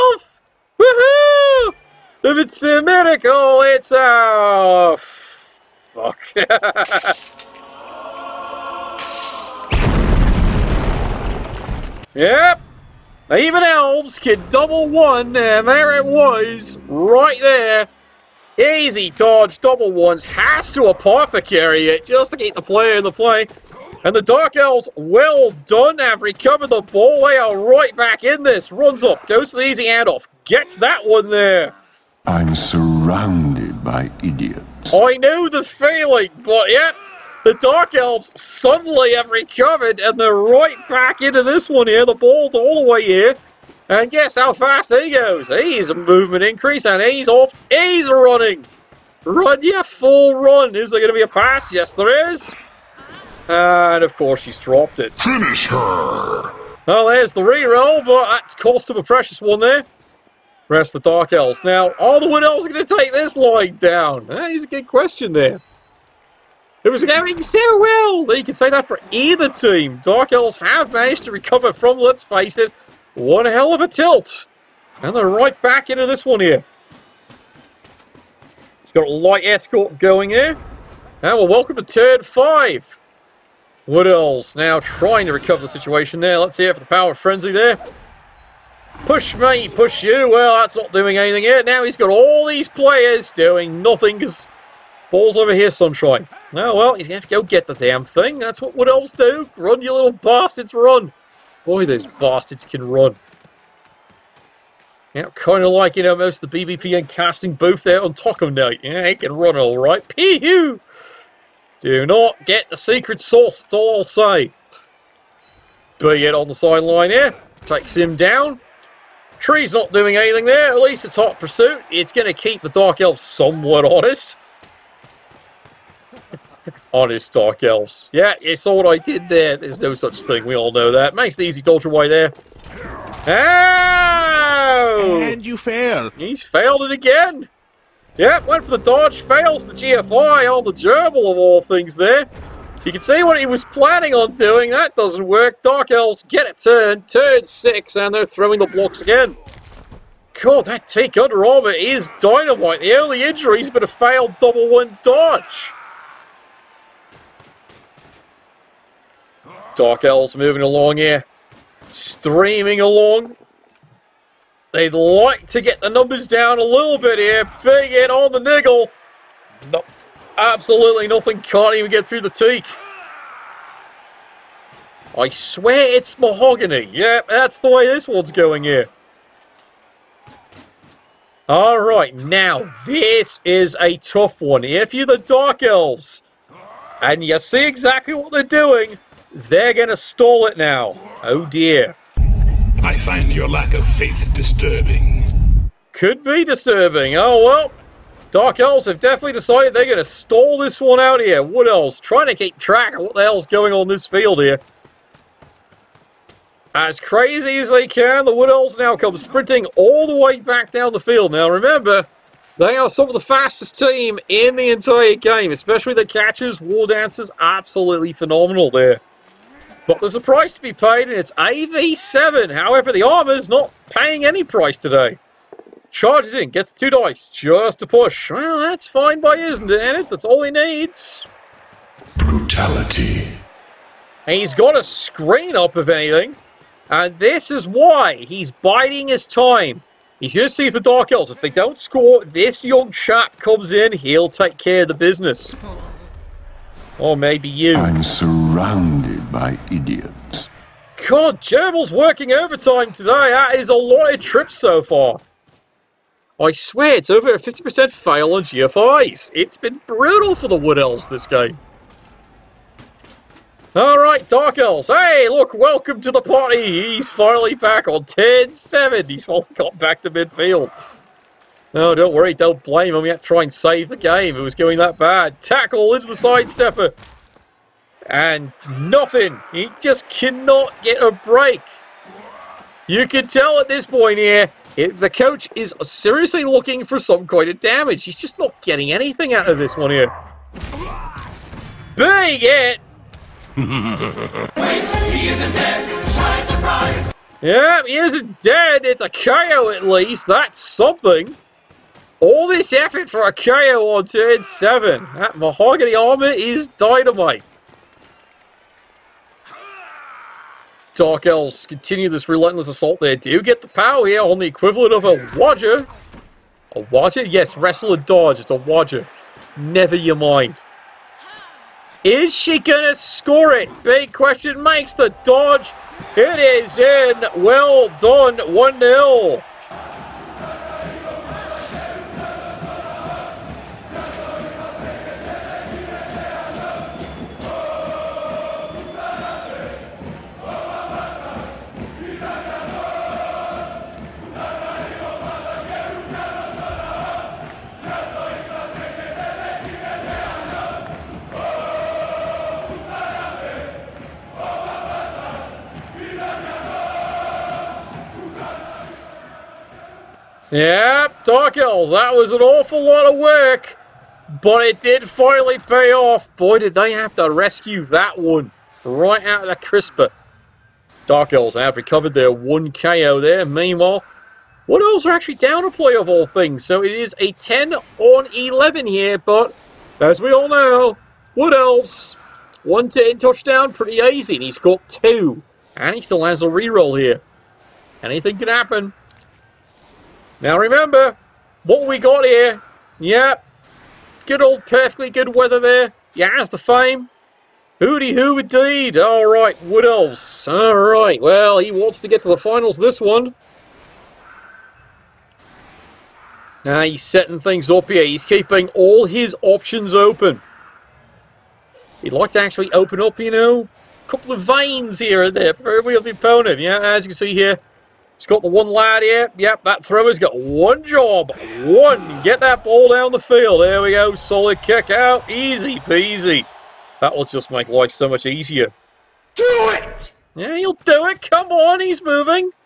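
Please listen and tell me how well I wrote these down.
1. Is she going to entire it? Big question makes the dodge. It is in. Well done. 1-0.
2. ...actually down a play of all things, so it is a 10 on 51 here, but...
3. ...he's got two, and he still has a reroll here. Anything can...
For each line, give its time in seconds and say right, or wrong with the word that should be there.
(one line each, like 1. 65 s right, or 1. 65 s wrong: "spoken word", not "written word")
1. 322 s wrong: "score", not "entire"
2. 375 s wrong: "11", not "51"
3. 384 s right.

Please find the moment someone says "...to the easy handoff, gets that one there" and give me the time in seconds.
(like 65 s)
29 s.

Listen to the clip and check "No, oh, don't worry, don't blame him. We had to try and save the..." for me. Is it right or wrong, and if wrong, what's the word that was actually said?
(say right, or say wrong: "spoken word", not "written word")
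right.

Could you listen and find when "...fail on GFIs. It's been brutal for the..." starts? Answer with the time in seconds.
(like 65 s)
257 s.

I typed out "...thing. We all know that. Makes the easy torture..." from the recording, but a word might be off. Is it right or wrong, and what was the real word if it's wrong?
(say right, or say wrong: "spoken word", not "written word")
right.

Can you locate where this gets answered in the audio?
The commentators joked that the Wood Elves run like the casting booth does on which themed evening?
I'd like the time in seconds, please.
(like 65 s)
108 s.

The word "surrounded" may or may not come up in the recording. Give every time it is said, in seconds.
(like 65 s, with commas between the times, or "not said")
32 s, 248 s.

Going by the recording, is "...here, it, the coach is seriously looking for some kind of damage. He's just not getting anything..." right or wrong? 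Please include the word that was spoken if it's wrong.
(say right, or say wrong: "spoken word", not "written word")
right.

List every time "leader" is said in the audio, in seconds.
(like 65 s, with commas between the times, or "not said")
not said.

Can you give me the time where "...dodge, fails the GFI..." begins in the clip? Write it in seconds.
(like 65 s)
138 s.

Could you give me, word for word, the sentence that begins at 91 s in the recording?
Now he's got all these players doing nothing because Ball's over here, Sunshine.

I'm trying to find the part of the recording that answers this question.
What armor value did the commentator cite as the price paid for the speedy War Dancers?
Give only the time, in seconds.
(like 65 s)
221 s.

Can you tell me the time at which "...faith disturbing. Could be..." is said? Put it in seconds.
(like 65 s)
193 s.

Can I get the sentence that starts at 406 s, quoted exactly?
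Now he's setting things up here.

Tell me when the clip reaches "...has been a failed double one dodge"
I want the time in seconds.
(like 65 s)
153 s.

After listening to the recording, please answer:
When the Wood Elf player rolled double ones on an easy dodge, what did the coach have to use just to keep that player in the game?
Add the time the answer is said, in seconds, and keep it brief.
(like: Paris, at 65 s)
Apothecary, at 20 s.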